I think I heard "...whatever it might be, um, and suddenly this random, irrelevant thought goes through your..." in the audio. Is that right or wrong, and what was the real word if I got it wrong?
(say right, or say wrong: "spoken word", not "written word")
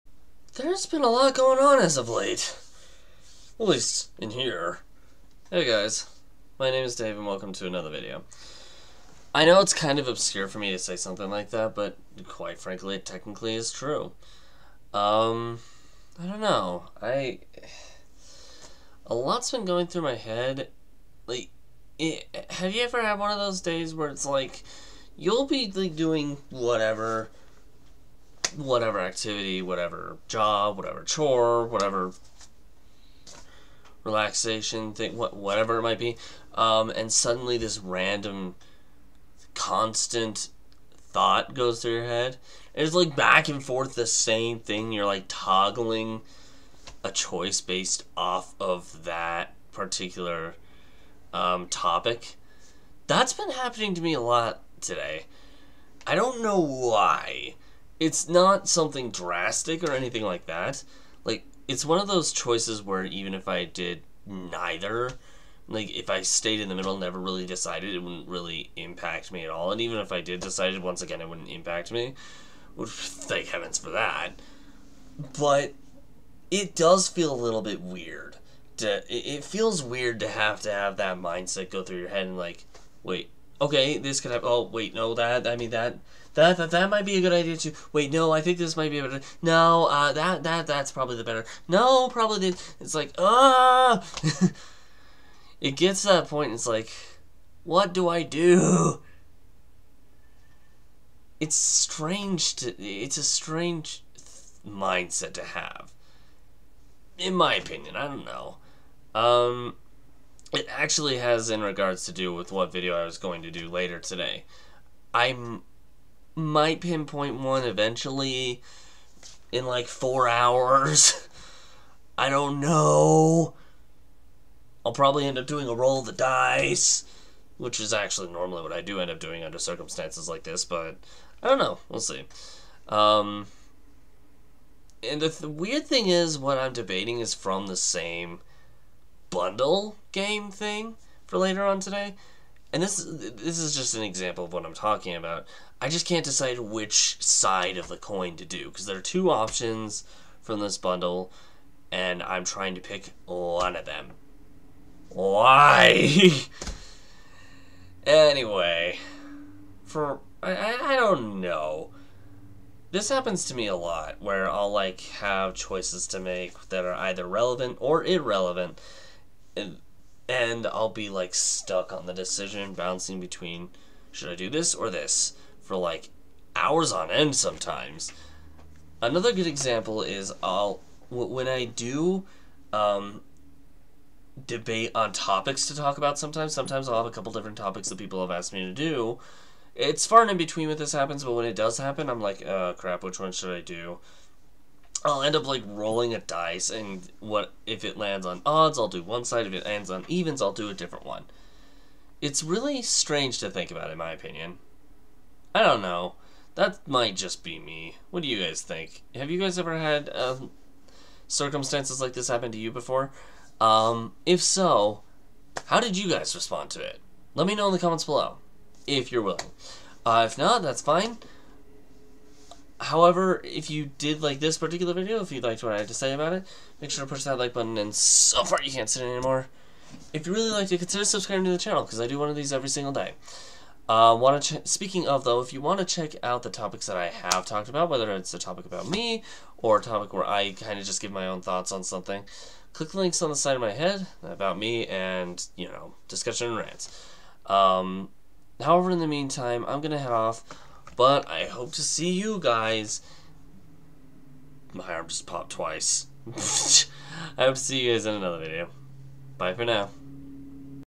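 wrong: "constant", not "irrelevant".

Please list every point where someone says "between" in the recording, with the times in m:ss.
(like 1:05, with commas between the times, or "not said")
2:53, 3:10.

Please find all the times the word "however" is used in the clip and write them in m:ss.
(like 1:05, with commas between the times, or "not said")
3:42, 4:08.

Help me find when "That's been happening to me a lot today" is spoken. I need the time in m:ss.
0:53.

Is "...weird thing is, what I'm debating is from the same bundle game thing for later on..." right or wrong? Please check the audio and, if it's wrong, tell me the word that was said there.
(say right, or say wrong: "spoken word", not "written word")
right.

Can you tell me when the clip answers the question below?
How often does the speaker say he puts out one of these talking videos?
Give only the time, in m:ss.
3:52.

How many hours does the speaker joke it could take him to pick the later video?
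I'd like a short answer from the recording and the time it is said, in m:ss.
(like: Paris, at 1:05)
4, at 1:59.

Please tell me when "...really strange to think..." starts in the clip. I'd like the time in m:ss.
3:22.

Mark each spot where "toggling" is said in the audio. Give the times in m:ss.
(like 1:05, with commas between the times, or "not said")
0:45.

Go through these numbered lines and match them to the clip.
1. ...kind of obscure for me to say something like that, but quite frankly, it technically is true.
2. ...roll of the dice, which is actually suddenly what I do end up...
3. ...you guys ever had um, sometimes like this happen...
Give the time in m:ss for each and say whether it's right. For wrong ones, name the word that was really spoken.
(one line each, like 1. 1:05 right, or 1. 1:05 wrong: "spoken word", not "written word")
1. 0:09 right
2. 2:05 wrong: "normally", not "suddenly"
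3. 3:29 wrong: "circumstances", not "sometimes".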